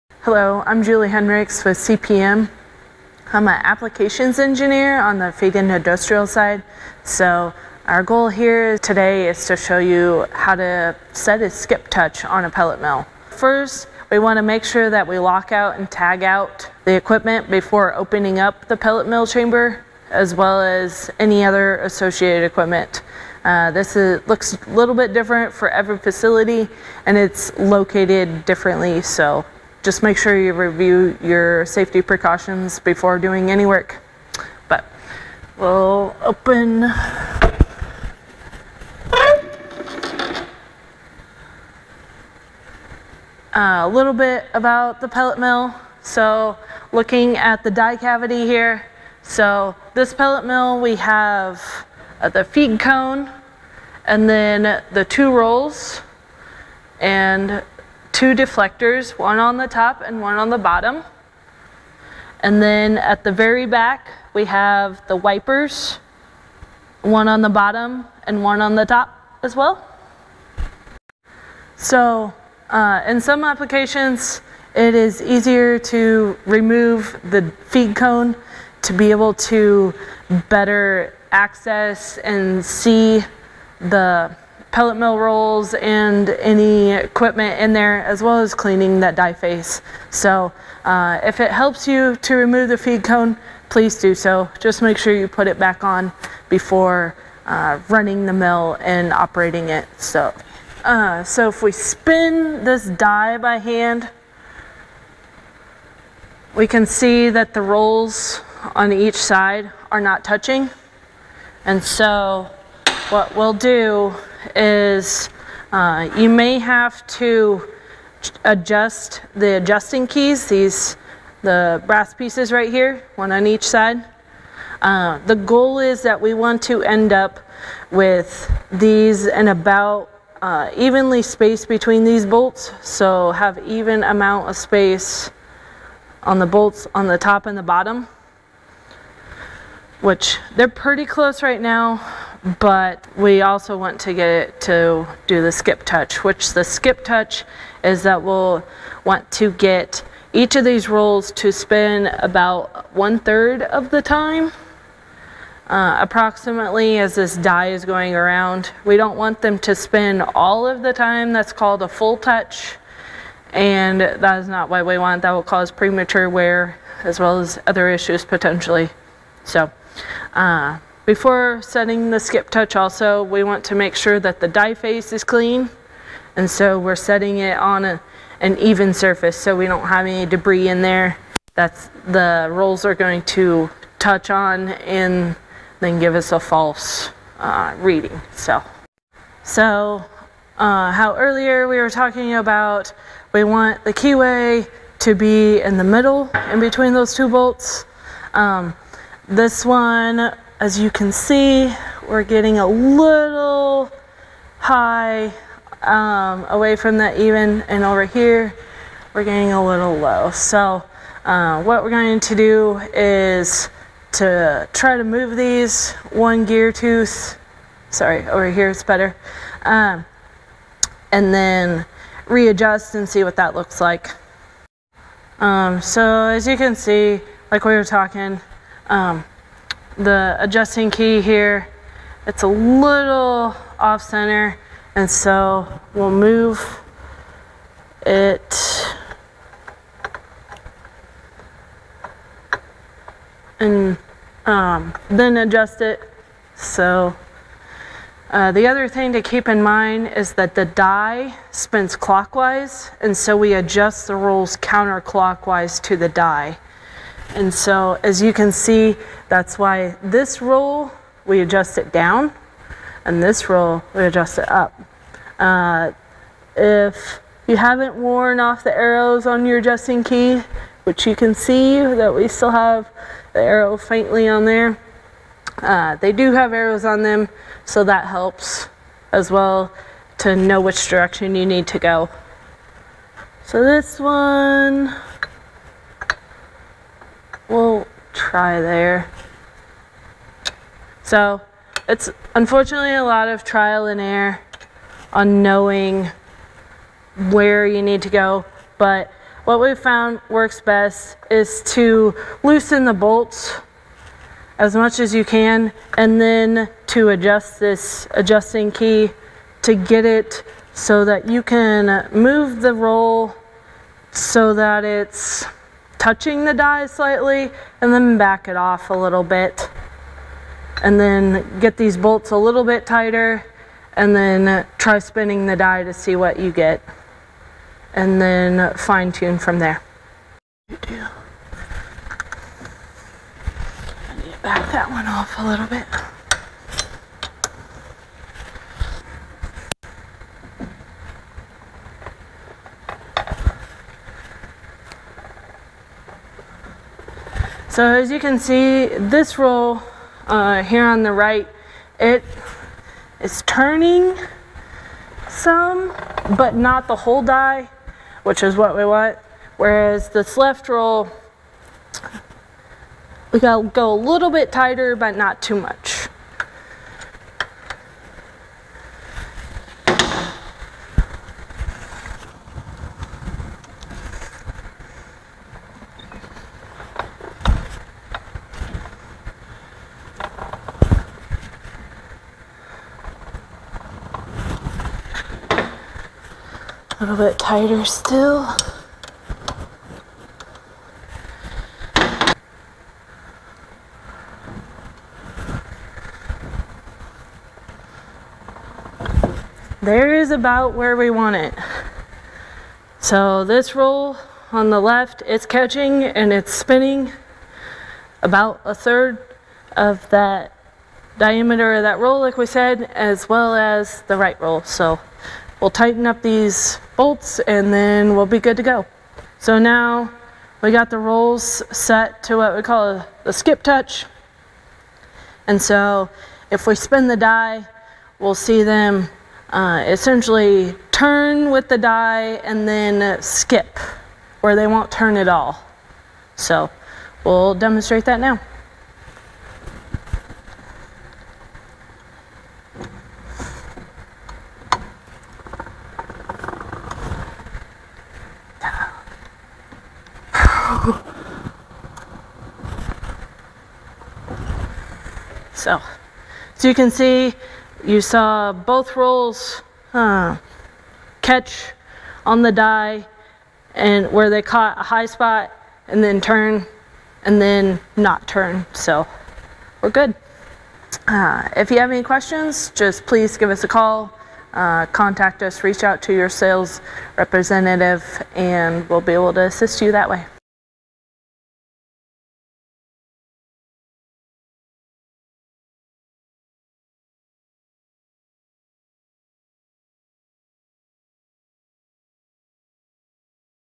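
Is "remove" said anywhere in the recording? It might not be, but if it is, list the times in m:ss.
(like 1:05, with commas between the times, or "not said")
1:16, 1:32.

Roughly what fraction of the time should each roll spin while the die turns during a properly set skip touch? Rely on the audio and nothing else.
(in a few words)
one third.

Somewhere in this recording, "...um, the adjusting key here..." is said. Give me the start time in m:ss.
3:48.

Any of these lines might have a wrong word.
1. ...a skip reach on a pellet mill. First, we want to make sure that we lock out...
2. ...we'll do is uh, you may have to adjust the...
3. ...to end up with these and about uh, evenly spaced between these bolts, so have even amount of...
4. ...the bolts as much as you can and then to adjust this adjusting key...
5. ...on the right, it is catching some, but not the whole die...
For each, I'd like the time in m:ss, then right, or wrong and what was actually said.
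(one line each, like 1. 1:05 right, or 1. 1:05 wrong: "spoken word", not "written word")
1. 0:11 wrong: "touch", not "reach"
2. 1:53 right
3. 2:06 right
4. 5:02 right
5. 5:50 wrong: "turning", not "catching".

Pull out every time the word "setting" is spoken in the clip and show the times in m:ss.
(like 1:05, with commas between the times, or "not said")
2:51, 2:56.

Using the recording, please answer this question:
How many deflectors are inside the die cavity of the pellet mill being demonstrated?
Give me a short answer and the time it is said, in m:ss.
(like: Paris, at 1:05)
2, at 0:58.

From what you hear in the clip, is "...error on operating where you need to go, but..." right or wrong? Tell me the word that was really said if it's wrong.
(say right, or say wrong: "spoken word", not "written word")
wrong: "knowing", not "operating".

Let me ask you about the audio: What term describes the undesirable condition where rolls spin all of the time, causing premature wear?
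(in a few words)
full touch.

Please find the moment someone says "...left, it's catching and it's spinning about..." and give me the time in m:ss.
6:44.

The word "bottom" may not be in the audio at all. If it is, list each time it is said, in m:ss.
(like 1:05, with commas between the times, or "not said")
1:00, 1:07, 2:17.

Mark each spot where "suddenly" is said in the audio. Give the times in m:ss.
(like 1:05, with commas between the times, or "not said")
not said.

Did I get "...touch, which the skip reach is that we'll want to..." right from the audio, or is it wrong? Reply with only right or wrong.
wrong.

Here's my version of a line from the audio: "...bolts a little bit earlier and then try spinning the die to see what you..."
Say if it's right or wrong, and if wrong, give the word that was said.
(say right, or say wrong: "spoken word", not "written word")
wrong: "tighter", not "earlier".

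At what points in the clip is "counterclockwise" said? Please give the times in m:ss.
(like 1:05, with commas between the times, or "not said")
4:14.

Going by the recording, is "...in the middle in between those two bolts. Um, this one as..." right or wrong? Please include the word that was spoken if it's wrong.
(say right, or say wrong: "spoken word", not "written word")
right.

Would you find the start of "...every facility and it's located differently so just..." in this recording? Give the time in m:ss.
0:25.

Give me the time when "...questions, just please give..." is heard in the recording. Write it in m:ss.
7:52.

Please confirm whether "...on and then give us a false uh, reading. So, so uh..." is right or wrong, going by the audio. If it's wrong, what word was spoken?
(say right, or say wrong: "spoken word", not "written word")
right.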